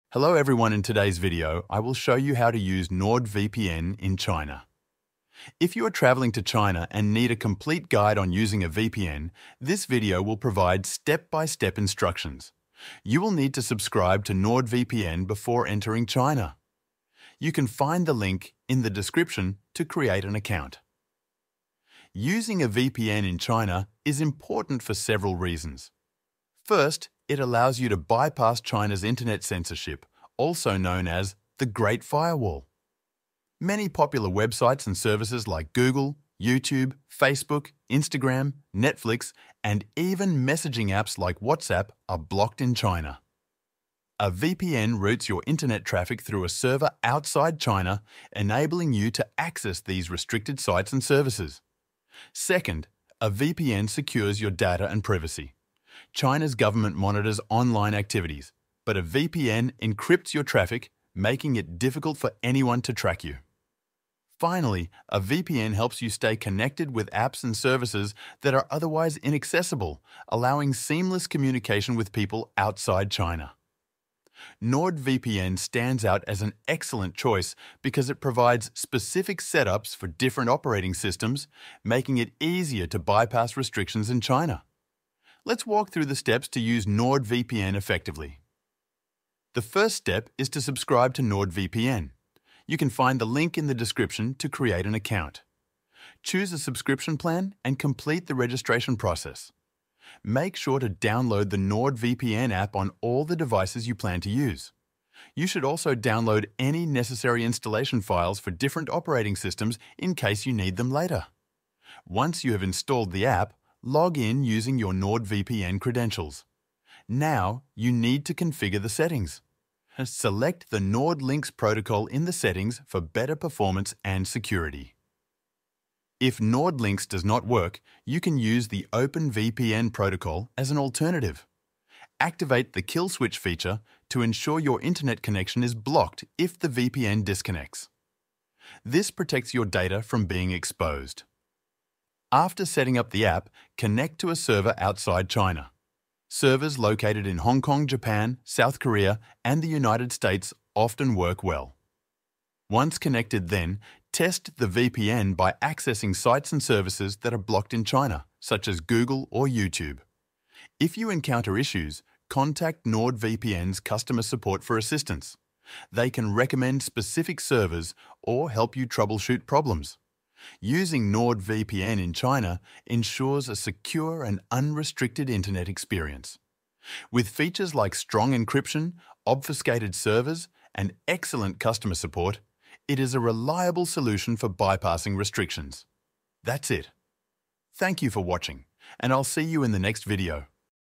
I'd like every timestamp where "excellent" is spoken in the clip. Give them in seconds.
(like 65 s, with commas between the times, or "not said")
76 s, 181 s.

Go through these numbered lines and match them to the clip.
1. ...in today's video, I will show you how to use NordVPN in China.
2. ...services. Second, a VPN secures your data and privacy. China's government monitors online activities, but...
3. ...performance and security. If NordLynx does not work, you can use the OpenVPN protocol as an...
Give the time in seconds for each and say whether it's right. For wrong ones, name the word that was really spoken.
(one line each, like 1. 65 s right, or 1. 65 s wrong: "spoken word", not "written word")
1. 0 s right
2. 51 s right
3. 123 s right.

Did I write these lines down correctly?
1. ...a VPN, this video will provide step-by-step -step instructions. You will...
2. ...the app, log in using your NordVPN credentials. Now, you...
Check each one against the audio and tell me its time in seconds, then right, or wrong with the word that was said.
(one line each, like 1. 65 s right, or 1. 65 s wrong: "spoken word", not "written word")
1. 8 s right
2. 113 s right.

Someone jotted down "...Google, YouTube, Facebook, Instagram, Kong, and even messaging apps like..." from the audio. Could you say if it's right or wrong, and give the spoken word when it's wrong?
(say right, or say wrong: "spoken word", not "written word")
wrong: "Netflix", not "Kong".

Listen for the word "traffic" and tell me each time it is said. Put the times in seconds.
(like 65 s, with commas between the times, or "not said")
45 s, 60 s.